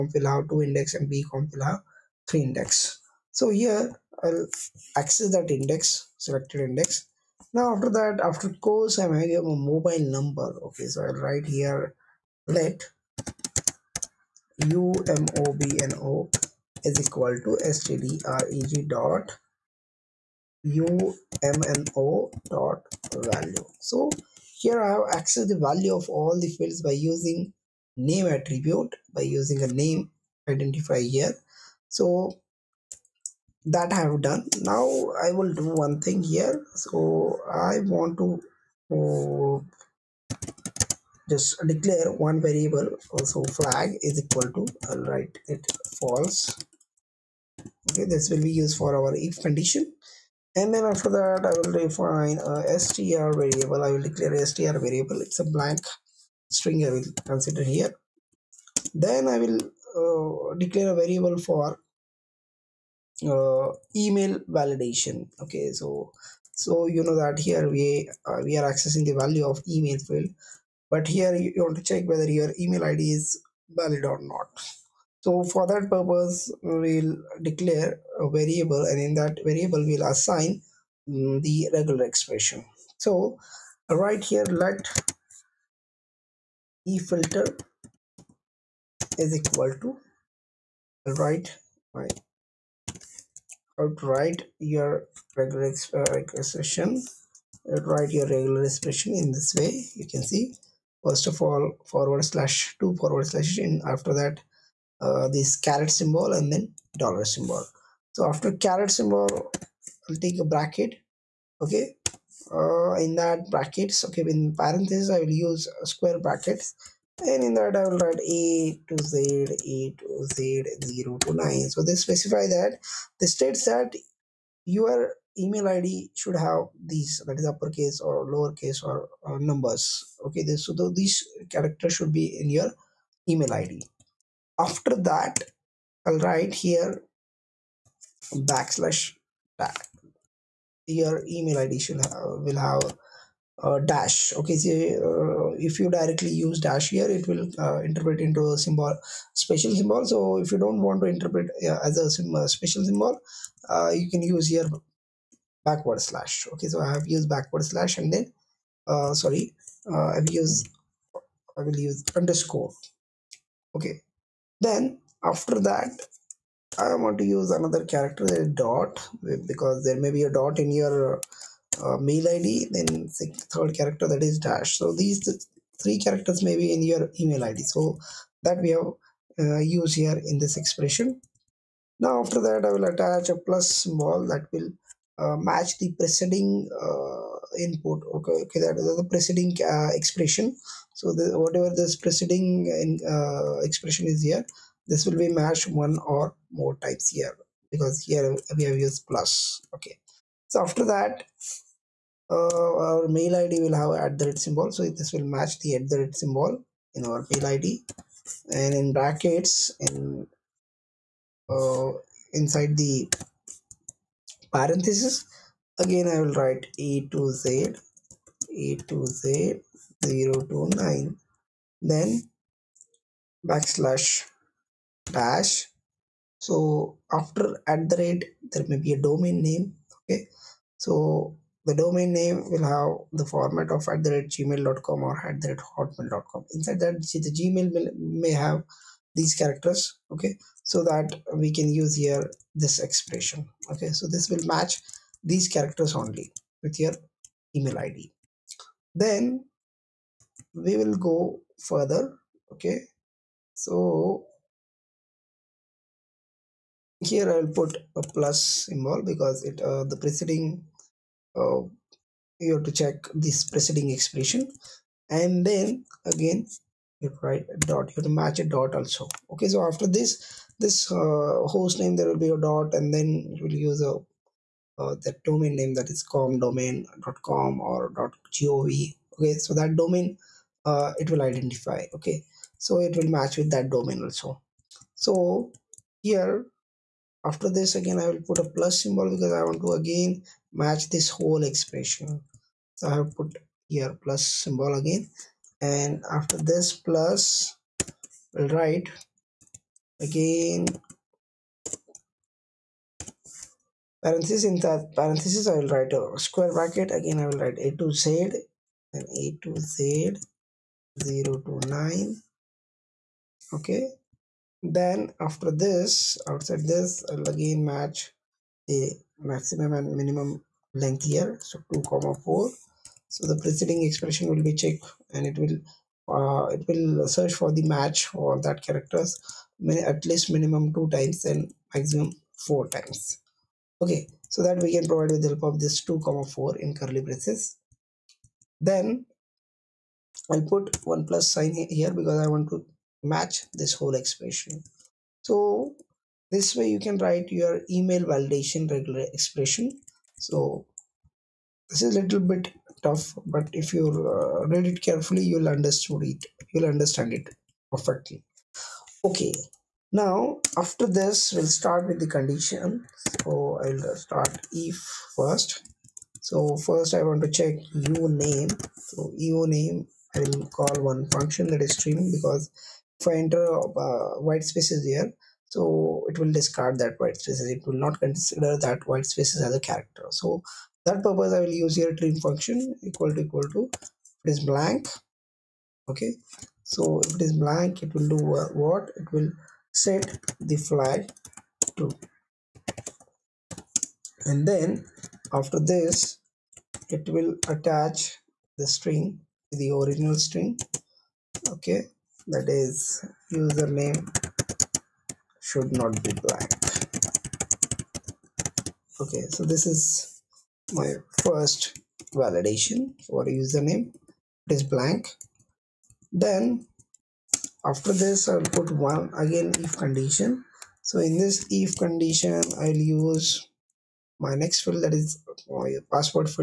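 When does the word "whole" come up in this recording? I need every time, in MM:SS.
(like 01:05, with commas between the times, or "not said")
04:51, 05:43.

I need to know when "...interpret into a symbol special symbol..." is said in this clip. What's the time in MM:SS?
02:27.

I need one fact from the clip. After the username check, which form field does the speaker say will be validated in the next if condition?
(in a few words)
password.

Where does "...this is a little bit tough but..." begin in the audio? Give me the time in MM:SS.
05:51.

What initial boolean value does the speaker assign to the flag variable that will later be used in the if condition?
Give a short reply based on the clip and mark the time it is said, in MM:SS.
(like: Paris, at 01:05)
false, at 00:45.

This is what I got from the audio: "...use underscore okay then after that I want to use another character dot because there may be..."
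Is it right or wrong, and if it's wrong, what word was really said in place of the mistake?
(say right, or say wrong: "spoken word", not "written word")
right.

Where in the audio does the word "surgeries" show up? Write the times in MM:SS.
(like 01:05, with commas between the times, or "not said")
not said.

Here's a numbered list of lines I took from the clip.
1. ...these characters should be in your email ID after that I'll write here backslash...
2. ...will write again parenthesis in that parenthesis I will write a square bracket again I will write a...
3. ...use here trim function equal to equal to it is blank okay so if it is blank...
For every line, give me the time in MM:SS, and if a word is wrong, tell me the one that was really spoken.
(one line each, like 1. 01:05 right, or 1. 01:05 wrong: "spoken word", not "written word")
1. 02:10 right
2. 04:58 right
3. 06:21 right.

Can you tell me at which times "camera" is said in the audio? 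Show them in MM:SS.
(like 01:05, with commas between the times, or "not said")
not said.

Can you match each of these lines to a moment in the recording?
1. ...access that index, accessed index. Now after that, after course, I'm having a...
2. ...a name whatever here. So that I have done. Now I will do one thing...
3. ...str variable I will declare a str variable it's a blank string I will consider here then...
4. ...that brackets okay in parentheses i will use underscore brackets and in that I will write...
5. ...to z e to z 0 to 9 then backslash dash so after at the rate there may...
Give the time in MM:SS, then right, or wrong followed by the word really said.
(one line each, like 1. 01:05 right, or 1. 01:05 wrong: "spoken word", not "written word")
1. 00:04 wrong: "selected", not "accessed"
2. 00:29 wrong: "identifier", not "whatever"
3. 00:52 right
4. 01:53 wrong: "square", not "underscore"
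5. 03:37 right.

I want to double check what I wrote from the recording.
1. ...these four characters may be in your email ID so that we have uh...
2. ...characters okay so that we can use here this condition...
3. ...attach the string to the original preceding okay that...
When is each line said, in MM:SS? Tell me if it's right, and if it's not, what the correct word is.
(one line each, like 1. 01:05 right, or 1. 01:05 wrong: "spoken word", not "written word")
1. 02:54 wrong: "three", not "four"
2. 03:59 wrong: "expression", not "condition"
3. 06:37 wrong: "string", not "preceding".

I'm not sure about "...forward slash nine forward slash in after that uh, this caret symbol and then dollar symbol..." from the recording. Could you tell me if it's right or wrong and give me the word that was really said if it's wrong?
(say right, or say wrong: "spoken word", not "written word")
wrong: "two", not "nine".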